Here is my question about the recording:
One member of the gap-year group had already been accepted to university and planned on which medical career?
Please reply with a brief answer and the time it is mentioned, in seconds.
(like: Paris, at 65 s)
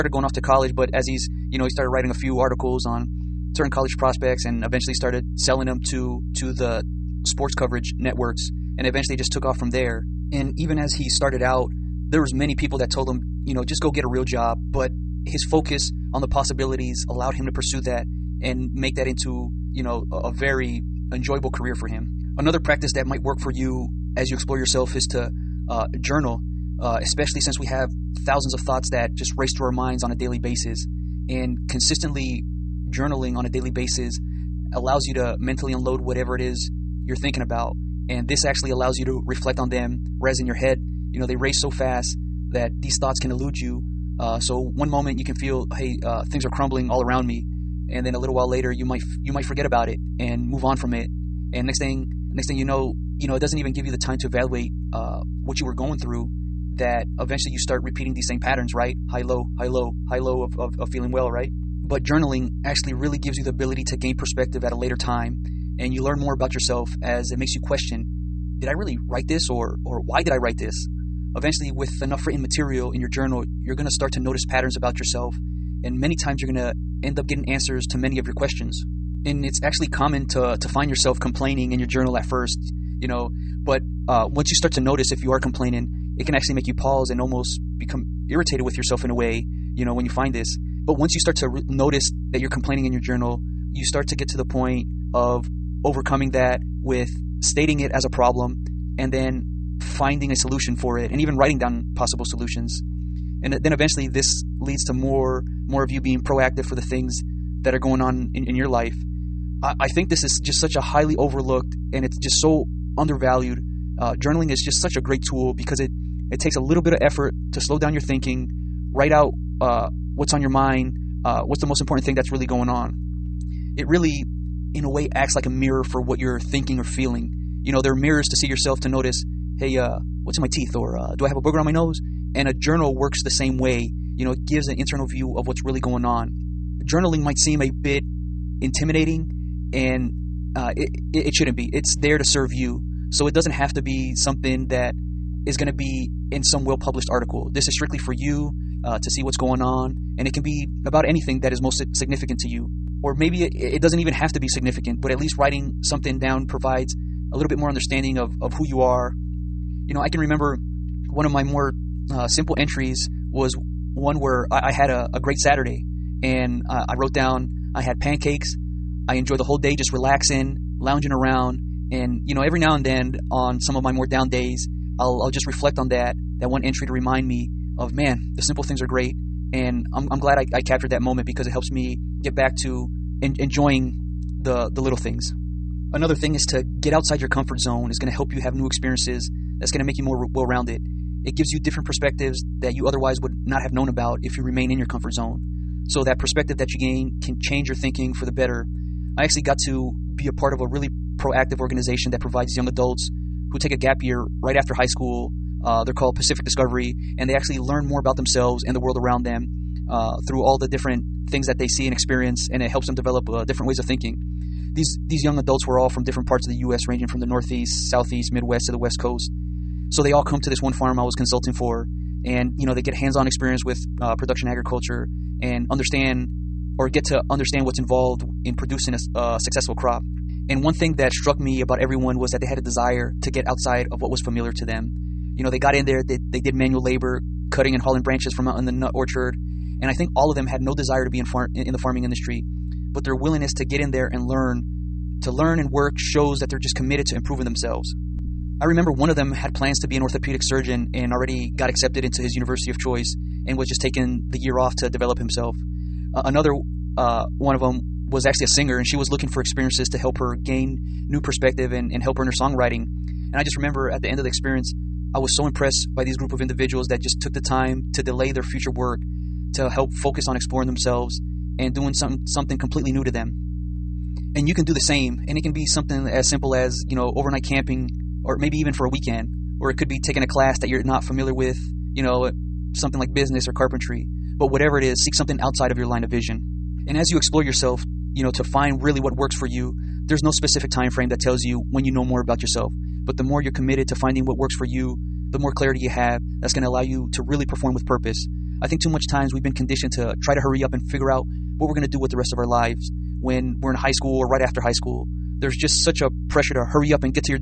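orthopedic surgeon, at 250 s.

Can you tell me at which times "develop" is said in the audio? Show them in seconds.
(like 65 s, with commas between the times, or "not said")
212 s, 254 s.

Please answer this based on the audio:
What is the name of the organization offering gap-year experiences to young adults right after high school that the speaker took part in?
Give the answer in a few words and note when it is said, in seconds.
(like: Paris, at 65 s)
Pacific Discovery, at 206 s.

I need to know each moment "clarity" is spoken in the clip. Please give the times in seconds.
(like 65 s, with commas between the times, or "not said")
295 s.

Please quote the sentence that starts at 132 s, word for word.
And a journal works the same way.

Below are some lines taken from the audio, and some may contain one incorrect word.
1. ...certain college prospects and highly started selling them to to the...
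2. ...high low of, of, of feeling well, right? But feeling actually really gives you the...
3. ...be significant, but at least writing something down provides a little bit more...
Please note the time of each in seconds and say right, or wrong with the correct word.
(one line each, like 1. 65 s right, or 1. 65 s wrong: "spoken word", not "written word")
1. 3 s wrong: "eventually", not "highly"
2. 60 s wrong: "journaling", not "feeling"
3. 154 s right.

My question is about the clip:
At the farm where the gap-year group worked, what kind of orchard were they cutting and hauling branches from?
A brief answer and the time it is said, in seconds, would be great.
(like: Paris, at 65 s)
nut orchard, at 238 s.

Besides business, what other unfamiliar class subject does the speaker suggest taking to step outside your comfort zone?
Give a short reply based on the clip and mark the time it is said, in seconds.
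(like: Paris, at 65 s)
carpentry, at 283 s.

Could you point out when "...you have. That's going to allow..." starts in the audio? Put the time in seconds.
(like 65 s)
295 s.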